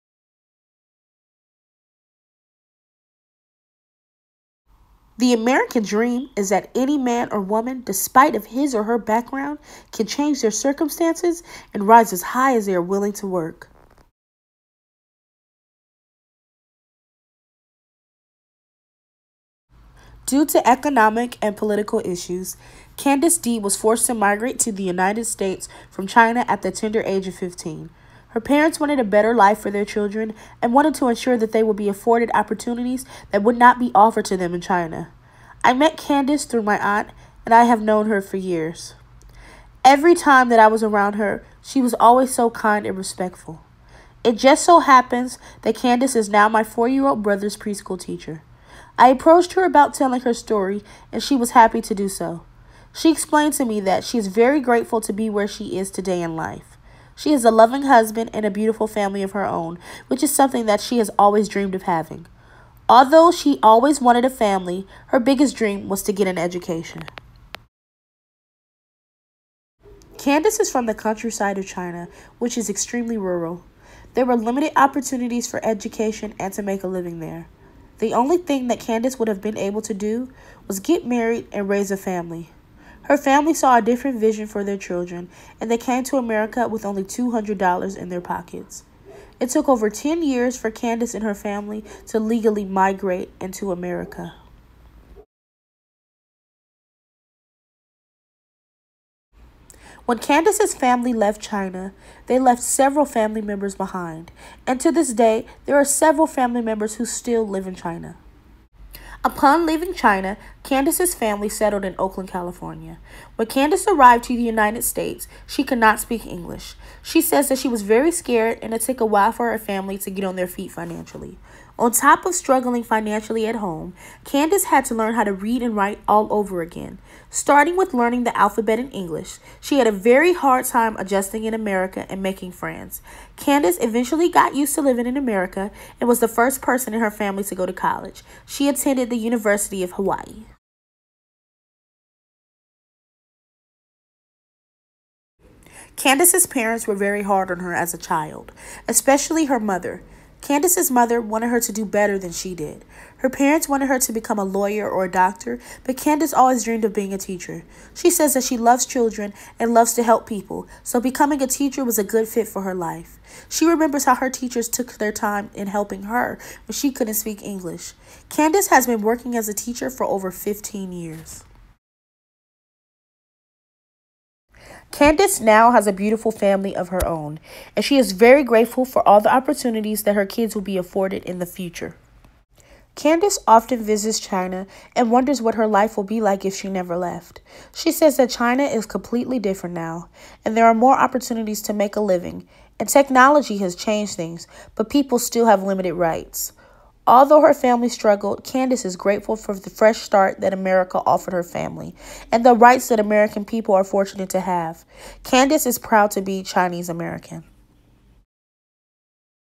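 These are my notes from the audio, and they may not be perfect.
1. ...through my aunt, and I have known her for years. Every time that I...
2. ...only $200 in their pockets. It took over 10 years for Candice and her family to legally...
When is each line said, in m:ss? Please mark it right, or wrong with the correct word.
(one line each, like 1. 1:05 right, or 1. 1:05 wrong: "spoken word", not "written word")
1. 0:36 right
2. 1:26 right.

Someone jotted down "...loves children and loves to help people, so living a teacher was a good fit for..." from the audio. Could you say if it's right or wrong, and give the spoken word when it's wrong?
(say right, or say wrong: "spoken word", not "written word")
wrong: "becoming", not "living".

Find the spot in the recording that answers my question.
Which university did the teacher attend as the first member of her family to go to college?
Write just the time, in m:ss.
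2:19.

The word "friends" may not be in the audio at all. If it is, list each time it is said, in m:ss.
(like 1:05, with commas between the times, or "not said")
2:12.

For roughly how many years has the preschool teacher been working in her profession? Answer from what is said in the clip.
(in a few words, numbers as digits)
over 15 years.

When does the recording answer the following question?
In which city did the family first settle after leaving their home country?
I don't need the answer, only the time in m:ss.
1:51.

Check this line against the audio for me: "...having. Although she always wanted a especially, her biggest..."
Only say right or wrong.
wrong.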